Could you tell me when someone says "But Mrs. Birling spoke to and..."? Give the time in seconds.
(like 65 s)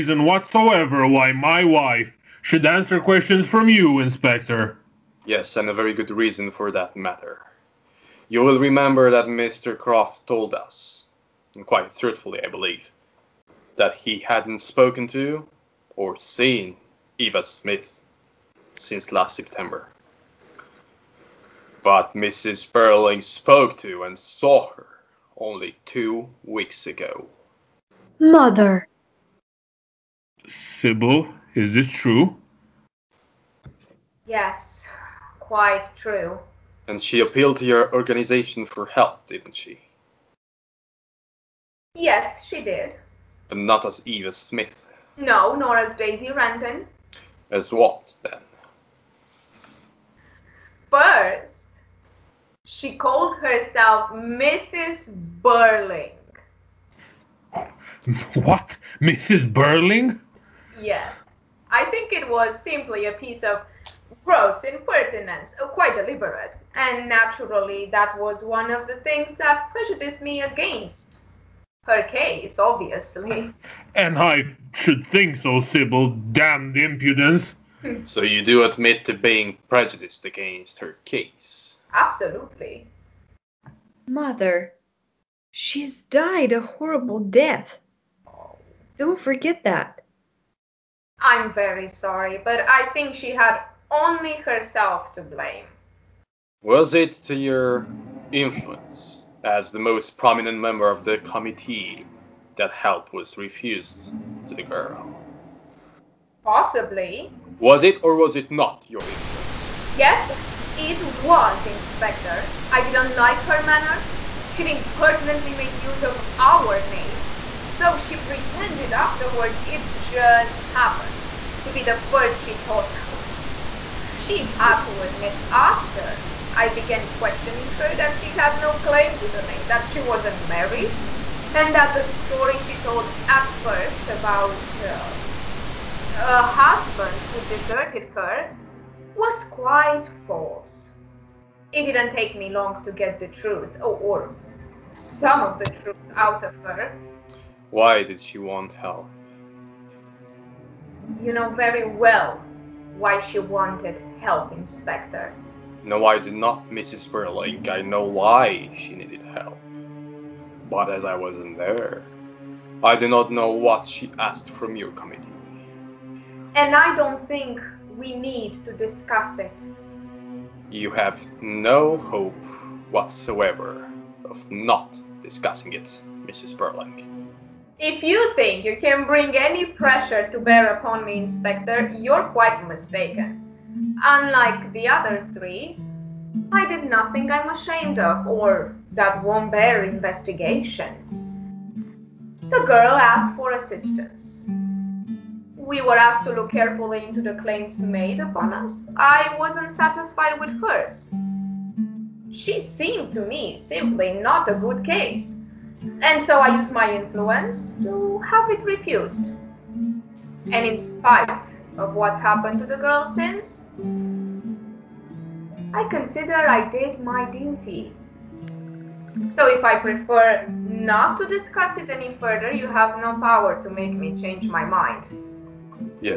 21 s.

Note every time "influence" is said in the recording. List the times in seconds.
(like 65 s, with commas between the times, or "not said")
98 s, 109 s, 206 s.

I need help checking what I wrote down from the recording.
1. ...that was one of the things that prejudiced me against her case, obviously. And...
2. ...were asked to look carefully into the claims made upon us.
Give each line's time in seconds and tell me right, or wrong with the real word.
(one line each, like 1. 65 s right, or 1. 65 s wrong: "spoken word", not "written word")
1. 67 s right
2. 195 s right.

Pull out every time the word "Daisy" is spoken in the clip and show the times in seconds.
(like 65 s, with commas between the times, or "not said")
45 s.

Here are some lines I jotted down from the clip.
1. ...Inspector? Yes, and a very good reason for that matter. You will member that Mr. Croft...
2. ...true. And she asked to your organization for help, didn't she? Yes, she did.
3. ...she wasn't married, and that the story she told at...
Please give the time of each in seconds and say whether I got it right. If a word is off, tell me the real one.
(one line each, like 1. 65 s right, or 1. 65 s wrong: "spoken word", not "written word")
1. 3 s wrong: "remember", not "member"
2. 35 s wrong: "appealed", not "asked"
3. 129 s right.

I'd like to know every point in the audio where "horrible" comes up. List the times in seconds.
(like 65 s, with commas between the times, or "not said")
86 s.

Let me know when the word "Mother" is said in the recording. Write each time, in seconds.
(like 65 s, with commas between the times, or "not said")
28 s, 84 s.